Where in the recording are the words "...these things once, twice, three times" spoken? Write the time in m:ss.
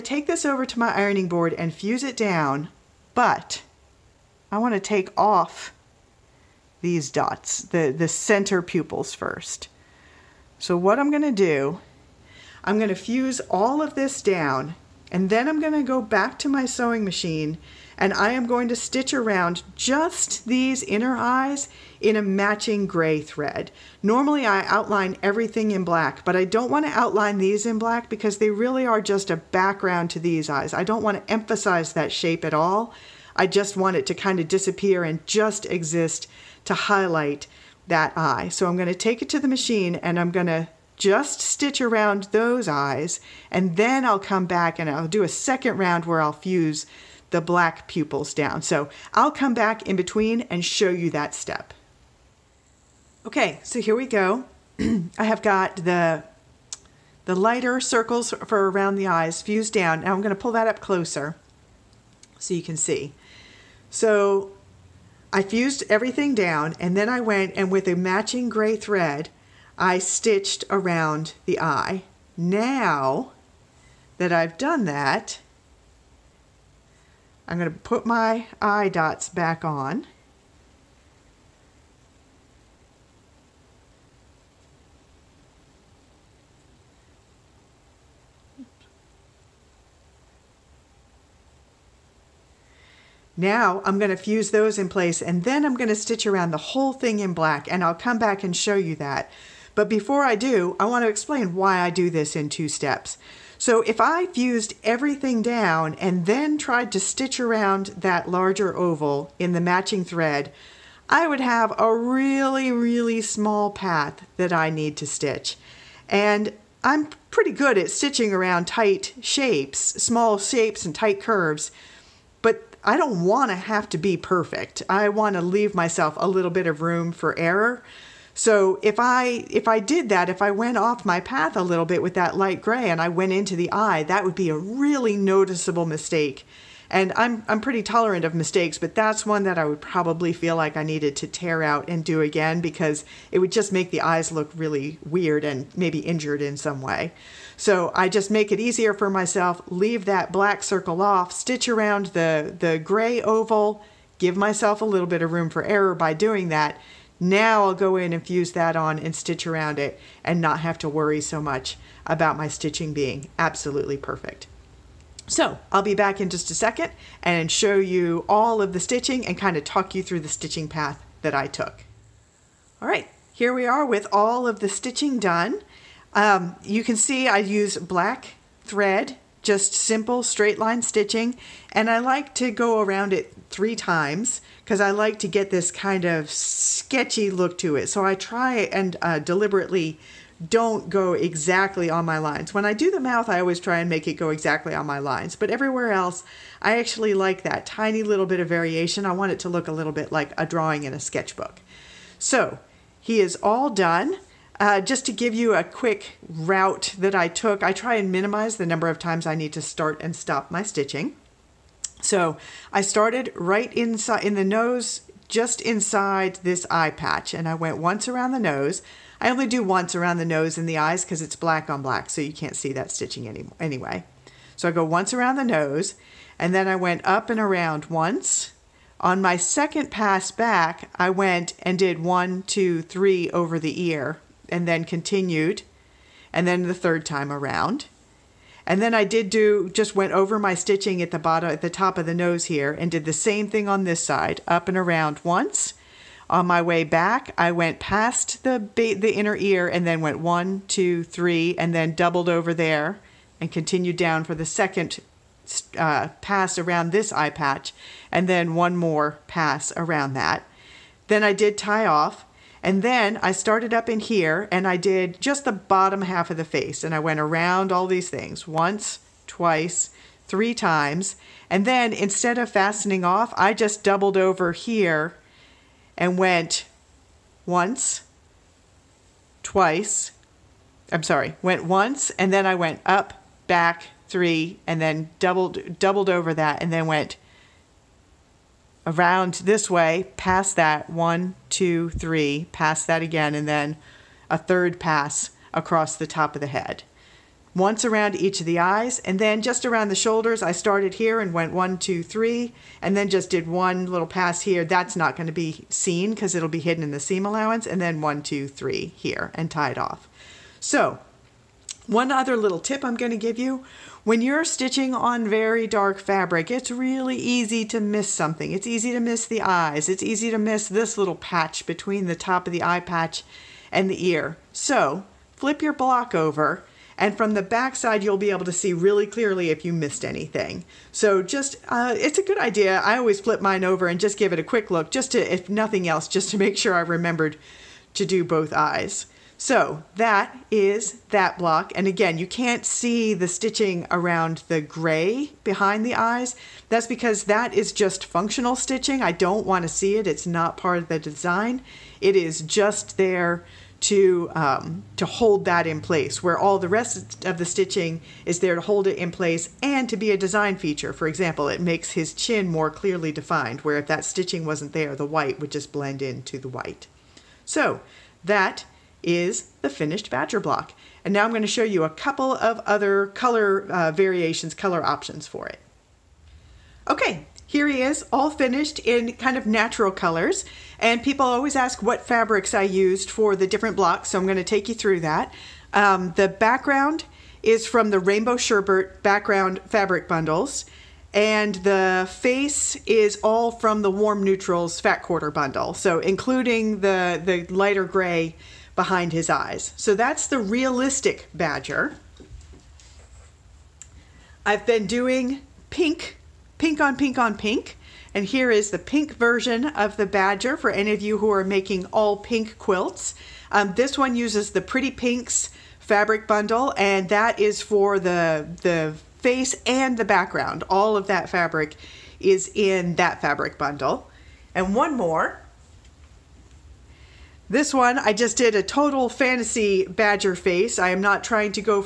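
4:27.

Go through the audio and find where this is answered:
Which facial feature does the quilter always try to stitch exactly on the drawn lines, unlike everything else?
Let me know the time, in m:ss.
3:12.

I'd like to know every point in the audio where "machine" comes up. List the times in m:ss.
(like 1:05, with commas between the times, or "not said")
0:17, 0:39.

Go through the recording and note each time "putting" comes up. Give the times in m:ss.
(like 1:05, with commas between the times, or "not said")
not said.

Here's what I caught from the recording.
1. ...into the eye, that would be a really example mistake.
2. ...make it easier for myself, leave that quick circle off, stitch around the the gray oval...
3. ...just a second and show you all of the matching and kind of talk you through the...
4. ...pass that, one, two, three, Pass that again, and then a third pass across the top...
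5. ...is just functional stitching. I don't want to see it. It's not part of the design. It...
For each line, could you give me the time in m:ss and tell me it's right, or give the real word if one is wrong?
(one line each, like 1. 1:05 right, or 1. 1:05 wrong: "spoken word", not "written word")
1. 2:13 wrong: "noticeable", not "example"
2. 2:28 wrong: "black", not "quick"
3. 2:46 wrong: "stitching", not "matching"
4. 4:50 right
5. 5:47 right.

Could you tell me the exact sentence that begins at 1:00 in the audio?
Now I'm gonna pull that up closer so you can see.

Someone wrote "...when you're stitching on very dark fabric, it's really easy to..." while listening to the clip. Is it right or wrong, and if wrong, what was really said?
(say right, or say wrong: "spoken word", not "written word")
right.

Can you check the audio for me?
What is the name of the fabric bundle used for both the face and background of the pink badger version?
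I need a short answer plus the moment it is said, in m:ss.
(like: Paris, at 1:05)
Pretty Pinks, at 6:54.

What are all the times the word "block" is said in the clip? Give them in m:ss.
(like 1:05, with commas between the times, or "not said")
5:25, 5:41, 6:10, 6:23.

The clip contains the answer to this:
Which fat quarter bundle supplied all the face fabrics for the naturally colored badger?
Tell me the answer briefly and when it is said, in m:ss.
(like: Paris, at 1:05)
warm neutrals, at 6:33.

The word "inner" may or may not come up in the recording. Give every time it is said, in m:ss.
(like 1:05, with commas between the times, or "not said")
0:20, 4:09.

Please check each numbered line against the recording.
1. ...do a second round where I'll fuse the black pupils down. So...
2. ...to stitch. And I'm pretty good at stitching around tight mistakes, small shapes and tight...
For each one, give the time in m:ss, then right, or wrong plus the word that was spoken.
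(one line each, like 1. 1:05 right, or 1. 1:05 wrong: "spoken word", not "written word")
1. 0:45 right
2. 1:54 wrong: "shapes", not "mistakes".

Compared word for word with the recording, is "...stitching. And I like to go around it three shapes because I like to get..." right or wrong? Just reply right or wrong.
wrong.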